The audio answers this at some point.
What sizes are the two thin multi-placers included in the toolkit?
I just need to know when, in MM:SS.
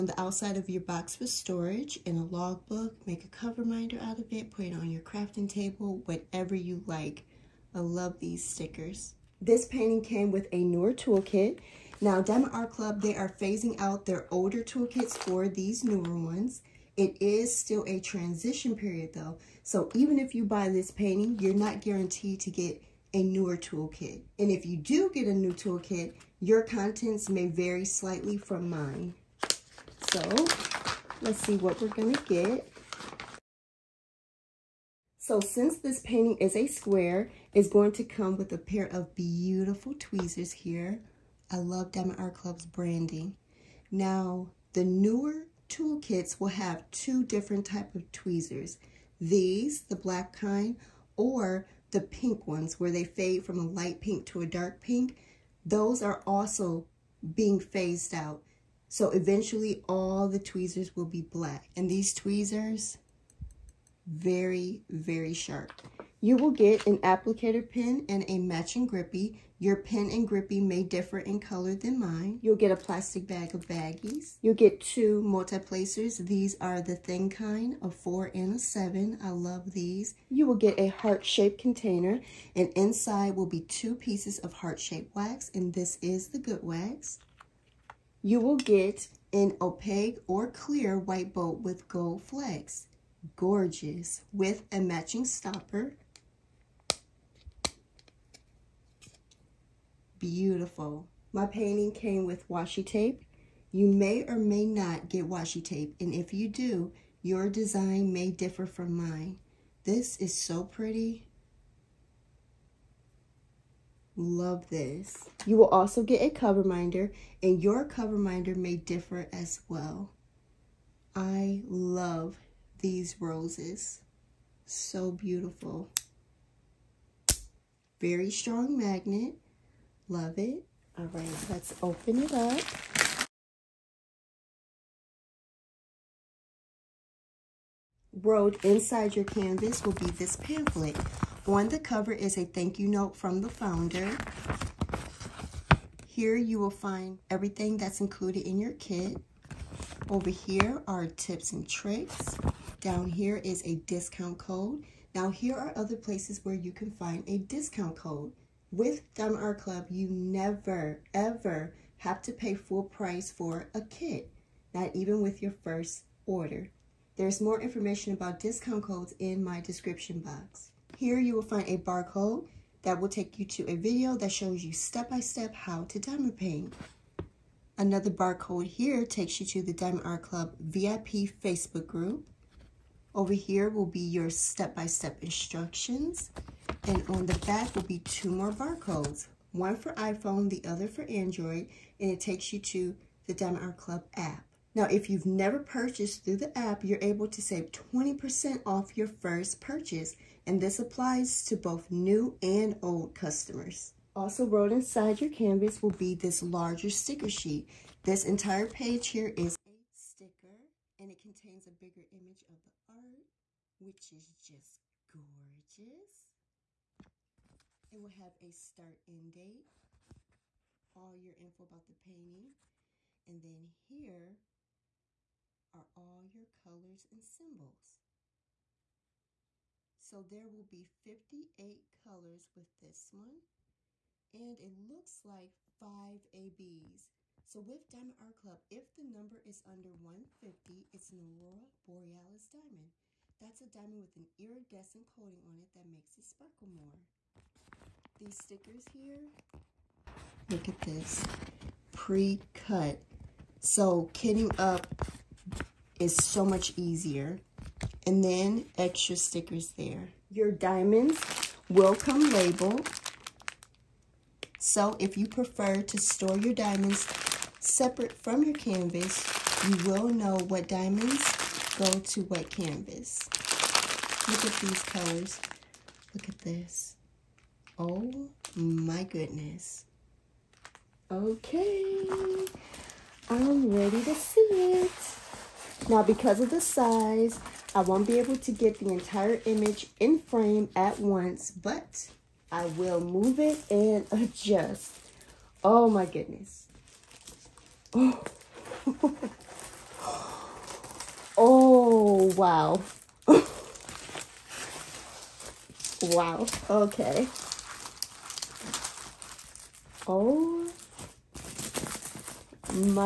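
01:17.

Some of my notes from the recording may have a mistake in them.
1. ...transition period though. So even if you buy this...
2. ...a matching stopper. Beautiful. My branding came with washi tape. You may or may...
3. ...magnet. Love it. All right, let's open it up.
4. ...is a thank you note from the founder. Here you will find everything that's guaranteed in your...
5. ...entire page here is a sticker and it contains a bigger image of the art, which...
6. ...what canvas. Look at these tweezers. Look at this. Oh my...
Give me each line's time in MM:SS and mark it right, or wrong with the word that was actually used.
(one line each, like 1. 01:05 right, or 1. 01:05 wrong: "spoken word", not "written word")
1. 00:17 right
2. 01:34 wrong: "painting", not "branding"
3. 02:08 right
4. 02:22 wrong: "included", not "guaranteed"
5. 03:28 right
6. 04:32 wrong: "colors", not "tweezers".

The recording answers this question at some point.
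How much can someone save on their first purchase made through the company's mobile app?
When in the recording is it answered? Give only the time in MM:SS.
03:17.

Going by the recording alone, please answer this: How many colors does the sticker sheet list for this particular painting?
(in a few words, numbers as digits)
58.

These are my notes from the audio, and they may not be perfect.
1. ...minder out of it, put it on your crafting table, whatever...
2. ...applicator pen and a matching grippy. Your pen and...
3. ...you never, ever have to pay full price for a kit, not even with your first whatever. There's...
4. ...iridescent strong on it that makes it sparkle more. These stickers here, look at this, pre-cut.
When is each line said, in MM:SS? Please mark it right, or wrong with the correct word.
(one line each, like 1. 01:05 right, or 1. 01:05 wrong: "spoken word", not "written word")
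1. 00:03 right
2. 01:06 right
3. 02:39 wrong: "order", not "whatever"
4. 04:04 wrong: "coating", not "strong".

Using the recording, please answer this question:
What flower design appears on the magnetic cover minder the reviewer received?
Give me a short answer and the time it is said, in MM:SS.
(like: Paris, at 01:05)
Roses, at 02:03.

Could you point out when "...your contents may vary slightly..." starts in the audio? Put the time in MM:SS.
00:26.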